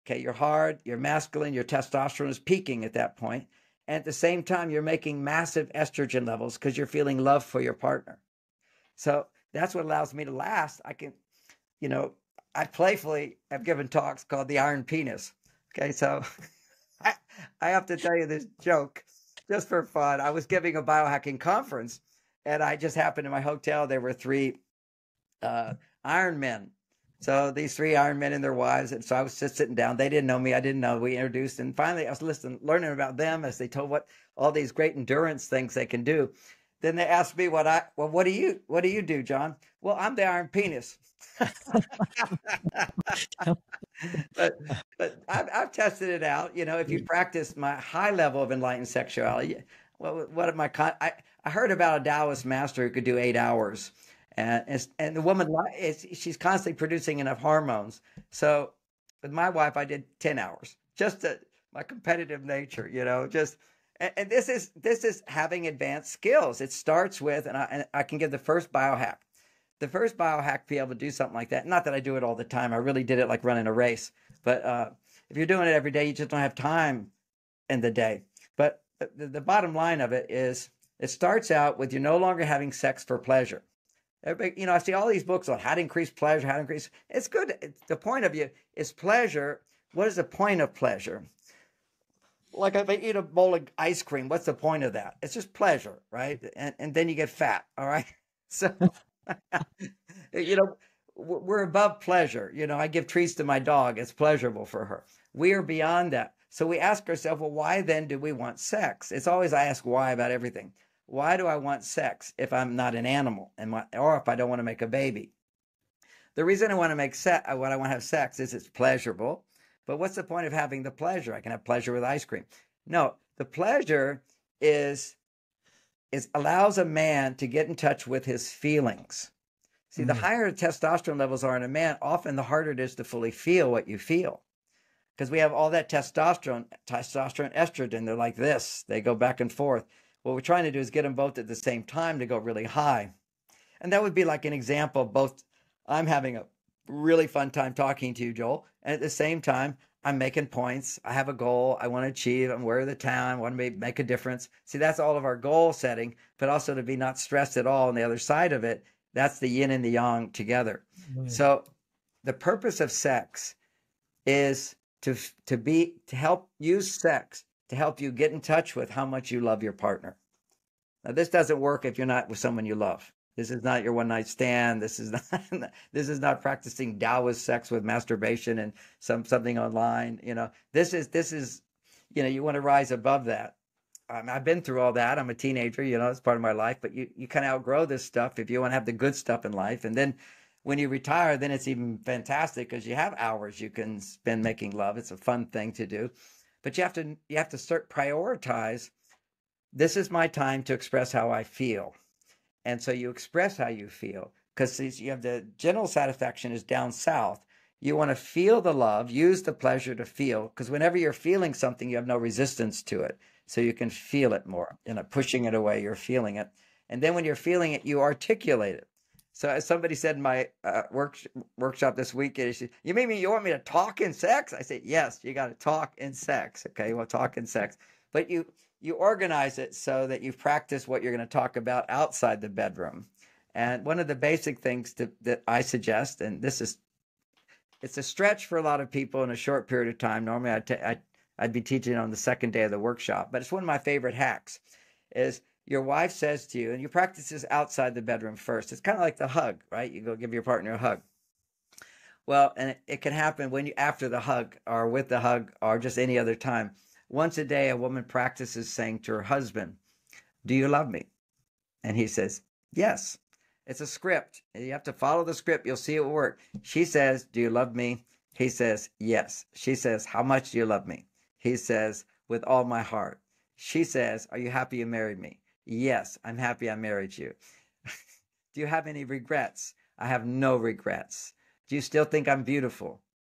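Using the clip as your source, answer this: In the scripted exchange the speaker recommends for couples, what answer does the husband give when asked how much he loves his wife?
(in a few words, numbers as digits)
With all my heart.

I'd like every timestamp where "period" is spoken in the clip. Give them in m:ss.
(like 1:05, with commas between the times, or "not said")
3:59.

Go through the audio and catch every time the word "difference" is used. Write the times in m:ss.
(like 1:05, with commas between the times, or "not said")
2:34.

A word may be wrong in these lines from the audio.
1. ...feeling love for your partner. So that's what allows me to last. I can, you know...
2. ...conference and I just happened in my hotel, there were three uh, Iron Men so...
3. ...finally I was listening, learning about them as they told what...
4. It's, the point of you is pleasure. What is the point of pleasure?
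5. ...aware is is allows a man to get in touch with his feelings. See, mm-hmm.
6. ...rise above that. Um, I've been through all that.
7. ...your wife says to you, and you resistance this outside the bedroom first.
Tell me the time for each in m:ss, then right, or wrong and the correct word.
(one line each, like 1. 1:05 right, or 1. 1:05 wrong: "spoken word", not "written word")
1. 0:06 right
2. 0:21 right
3. 0:31 right
4. 1:27 right
5. 2:03 wrong: "pleasure", not "aware"
6. 3:02 right
7. 4:05 wrong: "practice", not "resistance".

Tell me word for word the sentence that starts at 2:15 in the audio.
Because we have all that testosterone, testosterone, estrogen, they're like this.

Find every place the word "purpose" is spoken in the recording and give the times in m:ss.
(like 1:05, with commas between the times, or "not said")
2:42.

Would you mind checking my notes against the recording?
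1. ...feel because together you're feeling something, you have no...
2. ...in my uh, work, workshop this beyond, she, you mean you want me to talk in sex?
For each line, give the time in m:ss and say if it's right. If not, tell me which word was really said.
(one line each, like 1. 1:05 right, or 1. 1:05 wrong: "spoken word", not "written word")
1. 3:30 wrong: "whenever", not "together"
2. 3:40 wrong: "weekend", not "beyond".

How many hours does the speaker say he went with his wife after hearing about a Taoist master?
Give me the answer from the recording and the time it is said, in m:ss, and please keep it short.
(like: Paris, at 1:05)
10, at 1:00.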